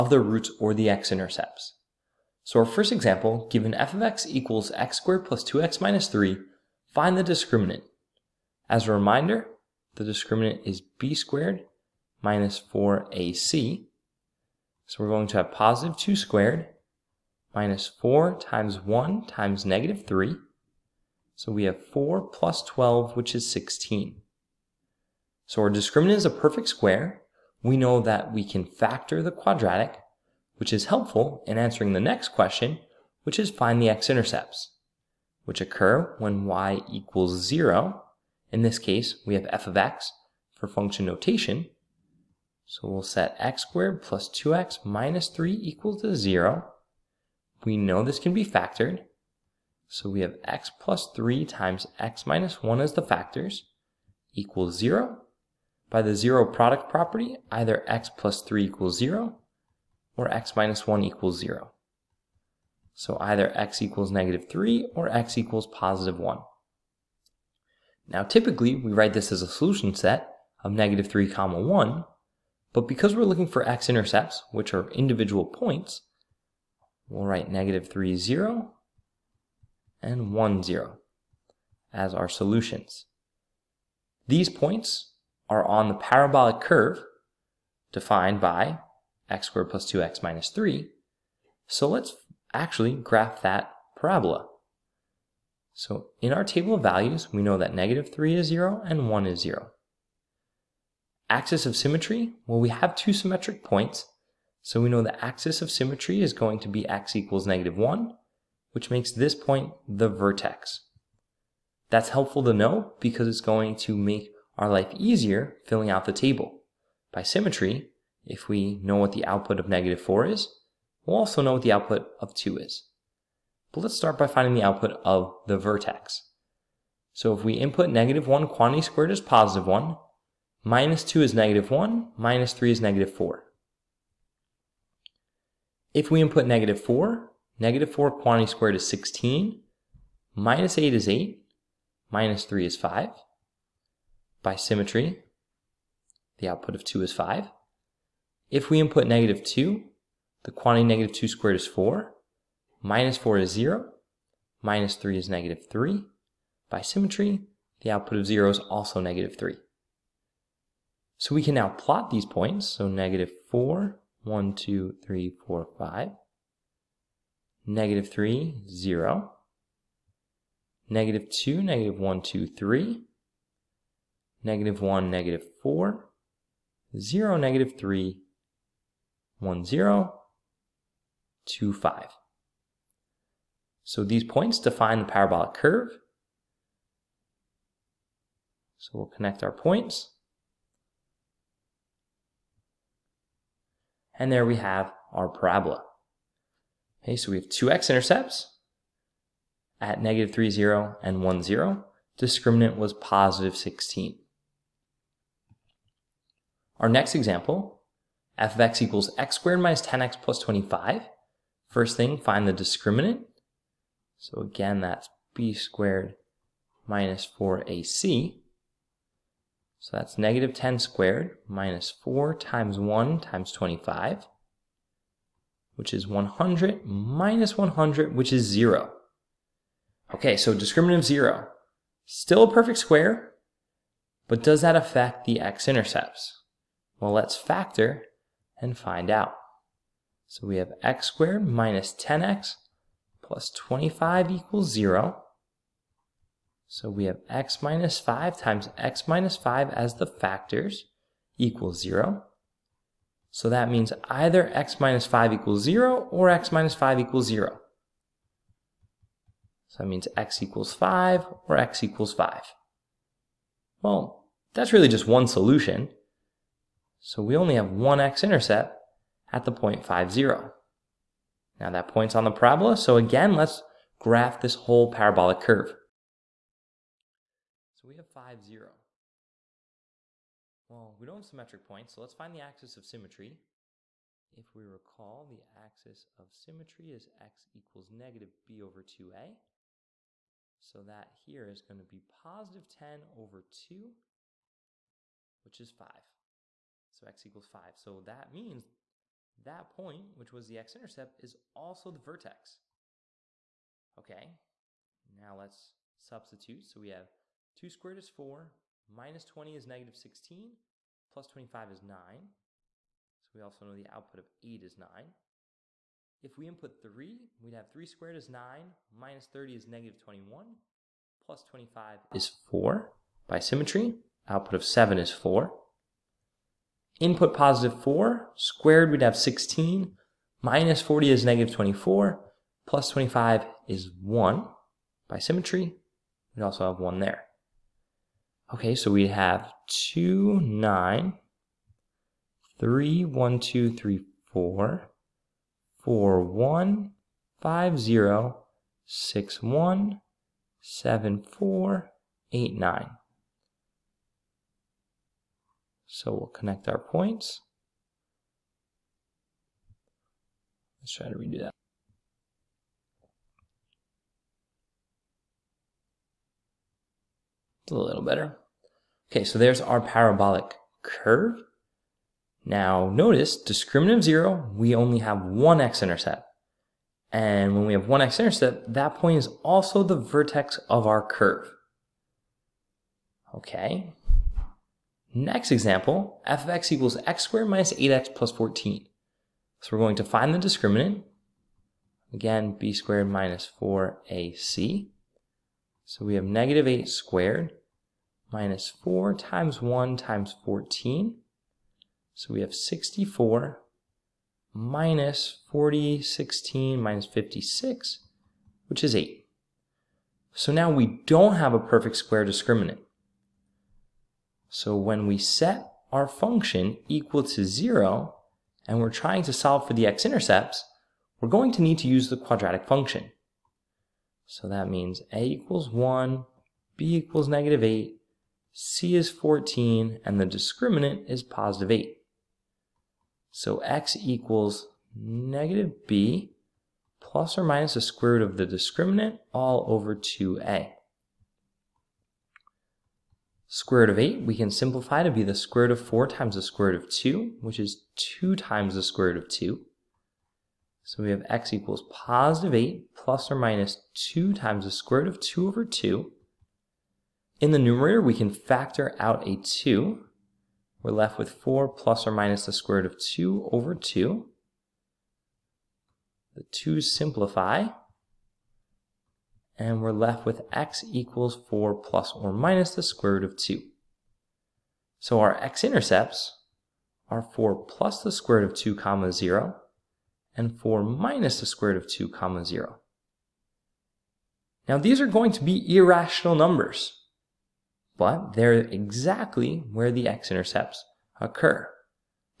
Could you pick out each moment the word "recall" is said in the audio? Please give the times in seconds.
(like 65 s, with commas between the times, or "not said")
284 s.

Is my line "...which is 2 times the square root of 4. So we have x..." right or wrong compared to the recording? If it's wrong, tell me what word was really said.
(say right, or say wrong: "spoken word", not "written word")
wrong: "2", not "4".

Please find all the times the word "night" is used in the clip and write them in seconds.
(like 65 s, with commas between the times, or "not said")
not said.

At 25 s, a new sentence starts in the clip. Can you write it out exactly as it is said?
So our discriminant is a perfect square.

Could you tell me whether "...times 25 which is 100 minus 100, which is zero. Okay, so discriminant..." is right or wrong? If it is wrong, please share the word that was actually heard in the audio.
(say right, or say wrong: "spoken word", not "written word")
right.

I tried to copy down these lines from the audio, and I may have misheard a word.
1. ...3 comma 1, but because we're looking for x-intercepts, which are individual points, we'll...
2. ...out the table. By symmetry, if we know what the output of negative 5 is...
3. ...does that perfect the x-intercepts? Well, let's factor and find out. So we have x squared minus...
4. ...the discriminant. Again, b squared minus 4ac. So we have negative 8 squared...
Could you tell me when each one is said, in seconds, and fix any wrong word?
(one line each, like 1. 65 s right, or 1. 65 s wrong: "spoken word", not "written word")
1. 71 s right
2. 115 s wrong: "4", not "5"
3. 234 s wrong: "affect", not "perfect"
4. 390 s right.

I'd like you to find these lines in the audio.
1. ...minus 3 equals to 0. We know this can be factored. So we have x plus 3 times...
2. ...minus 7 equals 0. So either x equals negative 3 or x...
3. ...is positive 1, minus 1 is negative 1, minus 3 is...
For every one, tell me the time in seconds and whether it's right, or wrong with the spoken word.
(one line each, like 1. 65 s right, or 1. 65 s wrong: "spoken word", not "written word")
1. 44 s right
2. 60 s wrong: "1", not "7"
3. 129 s wrong: "2", not "1".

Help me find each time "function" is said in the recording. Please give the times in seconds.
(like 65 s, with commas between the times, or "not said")
40 s, 416 s, 422 s.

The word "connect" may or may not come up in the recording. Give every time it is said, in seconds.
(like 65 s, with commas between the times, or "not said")
189 s, 356 s.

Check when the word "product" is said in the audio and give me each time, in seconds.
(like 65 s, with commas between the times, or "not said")
56 s.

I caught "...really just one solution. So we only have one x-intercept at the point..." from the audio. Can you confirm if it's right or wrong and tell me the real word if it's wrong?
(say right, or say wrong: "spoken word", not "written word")
right.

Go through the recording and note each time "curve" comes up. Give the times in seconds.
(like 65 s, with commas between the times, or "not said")
86 s, 185 s, 275 s, 370 s, 381 s.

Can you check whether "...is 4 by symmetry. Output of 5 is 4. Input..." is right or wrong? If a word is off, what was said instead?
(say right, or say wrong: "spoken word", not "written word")
wrong: "7", not "5".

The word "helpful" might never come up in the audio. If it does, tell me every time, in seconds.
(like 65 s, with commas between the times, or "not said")
30 s, 112 s.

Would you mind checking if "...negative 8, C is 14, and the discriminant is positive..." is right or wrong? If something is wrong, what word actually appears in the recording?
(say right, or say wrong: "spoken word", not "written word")
right.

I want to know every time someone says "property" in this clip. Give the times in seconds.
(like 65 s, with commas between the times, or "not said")
56 s.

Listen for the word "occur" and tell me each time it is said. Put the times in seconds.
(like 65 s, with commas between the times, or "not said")
35 s, 491 s.